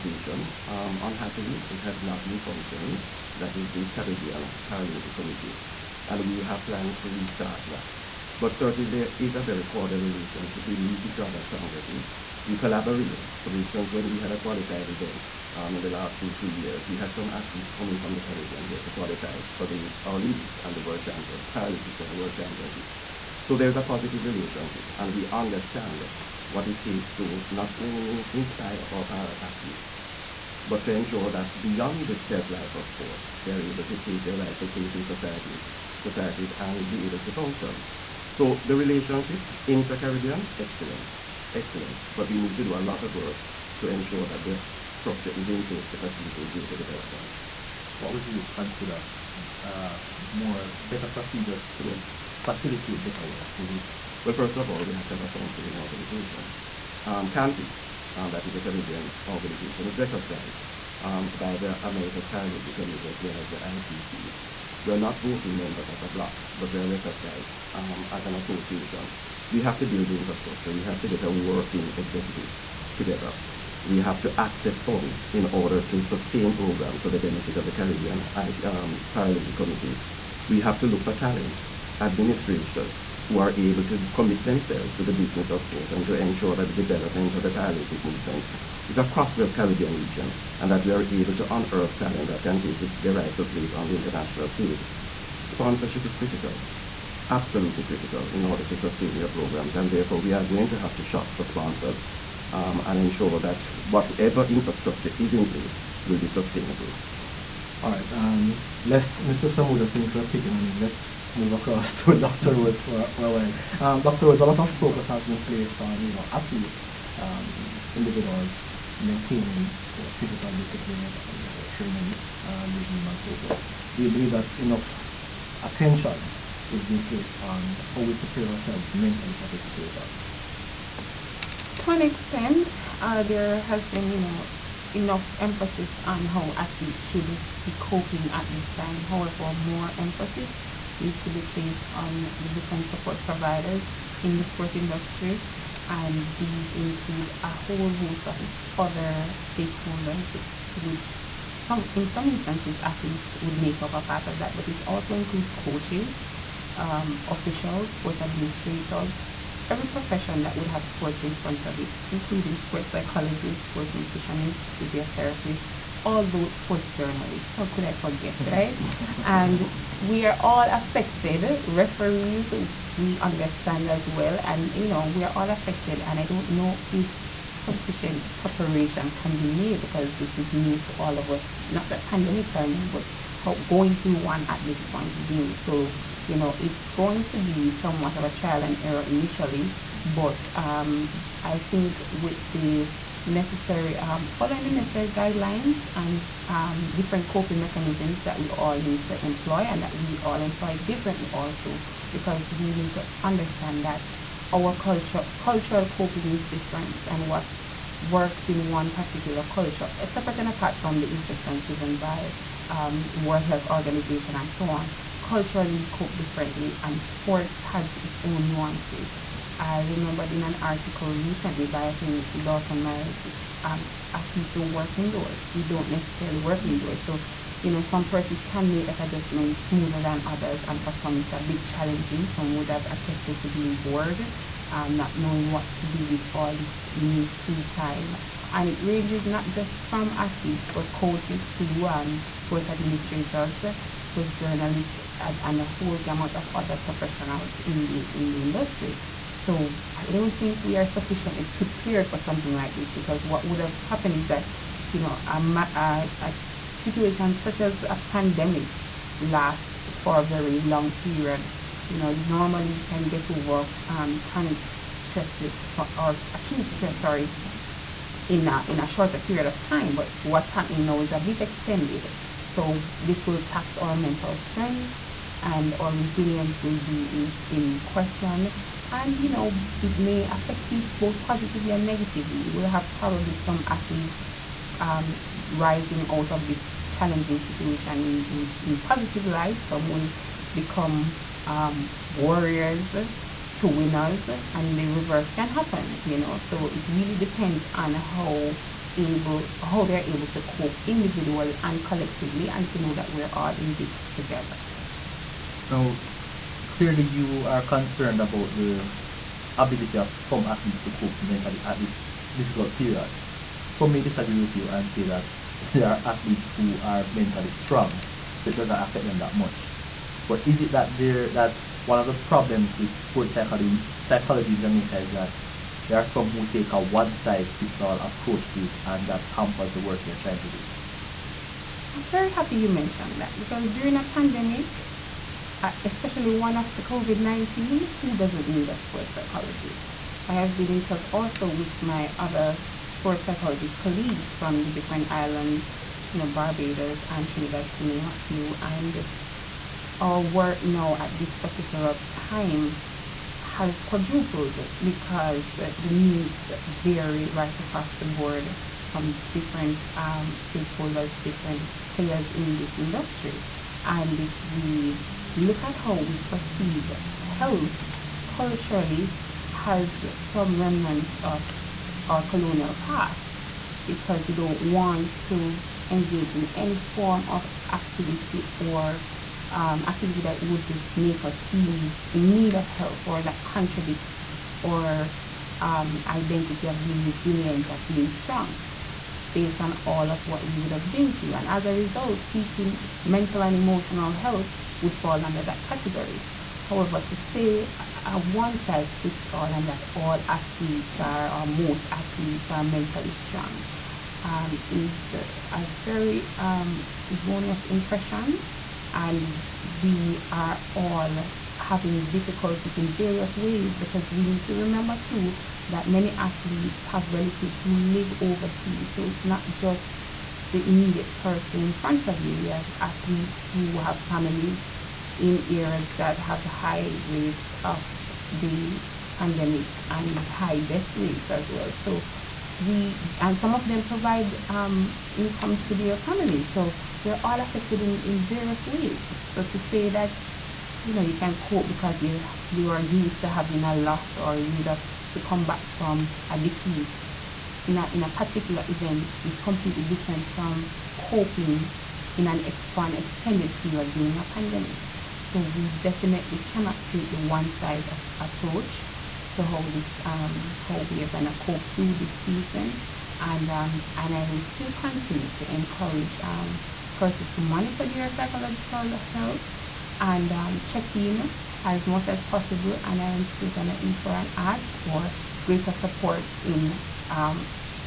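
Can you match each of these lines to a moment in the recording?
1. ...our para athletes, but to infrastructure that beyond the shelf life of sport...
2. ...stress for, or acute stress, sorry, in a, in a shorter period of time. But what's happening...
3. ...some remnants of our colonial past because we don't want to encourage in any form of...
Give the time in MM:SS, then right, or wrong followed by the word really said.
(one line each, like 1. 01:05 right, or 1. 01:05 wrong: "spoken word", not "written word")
1. 00:28 wrong: "ensure", not "infrastructure"
2. 04:24 right
3. 06:10 wrong: "engage", not "encourage".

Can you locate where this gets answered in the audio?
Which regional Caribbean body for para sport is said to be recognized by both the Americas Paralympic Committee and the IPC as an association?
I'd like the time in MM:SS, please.
00:57.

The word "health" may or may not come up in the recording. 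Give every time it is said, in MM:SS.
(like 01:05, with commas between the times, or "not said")
03:33, 06:07, 07:49.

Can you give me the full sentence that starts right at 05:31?
I'm very happy you mentioned that because during a pandemic, especially one after COVID 19, who doesn't need a sports psychologist?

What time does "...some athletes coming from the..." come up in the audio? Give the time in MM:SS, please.
00:17.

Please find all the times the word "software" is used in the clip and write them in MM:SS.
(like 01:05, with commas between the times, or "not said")
not said.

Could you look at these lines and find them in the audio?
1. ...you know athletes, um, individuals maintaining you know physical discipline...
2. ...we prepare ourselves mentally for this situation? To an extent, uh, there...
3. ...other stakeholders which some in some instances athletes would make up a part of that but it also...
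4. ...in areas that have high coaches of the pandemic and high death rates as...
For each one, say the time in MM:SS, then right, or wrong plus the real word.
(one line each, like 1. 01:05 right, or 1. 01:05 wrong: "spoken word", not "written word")
1. 01:56 right
2. 02:07 right
3. 02:28 right
4. 07:05 wrong: "rates", not "coaches".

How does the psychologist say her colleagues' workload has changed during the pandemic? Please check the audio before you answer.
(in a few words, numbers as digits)
Quadrupled.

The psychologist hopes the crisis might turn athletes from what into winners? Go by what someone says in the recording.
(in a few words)
Warriors.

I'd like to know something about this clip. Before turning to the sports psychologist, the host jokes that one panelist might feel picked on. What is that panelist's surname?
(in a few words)
Samuda.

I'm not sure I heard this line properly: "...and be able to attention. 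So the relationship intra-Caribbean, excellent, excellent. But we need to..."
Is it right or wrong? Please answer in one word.
wrong.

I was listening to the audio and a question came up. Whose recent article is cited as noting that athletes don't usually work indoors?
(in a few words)
Dalton Myers.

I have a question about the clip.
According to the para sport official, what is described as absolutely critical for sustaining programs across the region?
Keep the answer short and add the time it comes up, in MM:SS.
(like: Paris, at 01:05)
Sponsorship, at 01:35.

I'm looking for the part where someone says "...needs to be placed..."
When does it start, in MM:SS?
02:20.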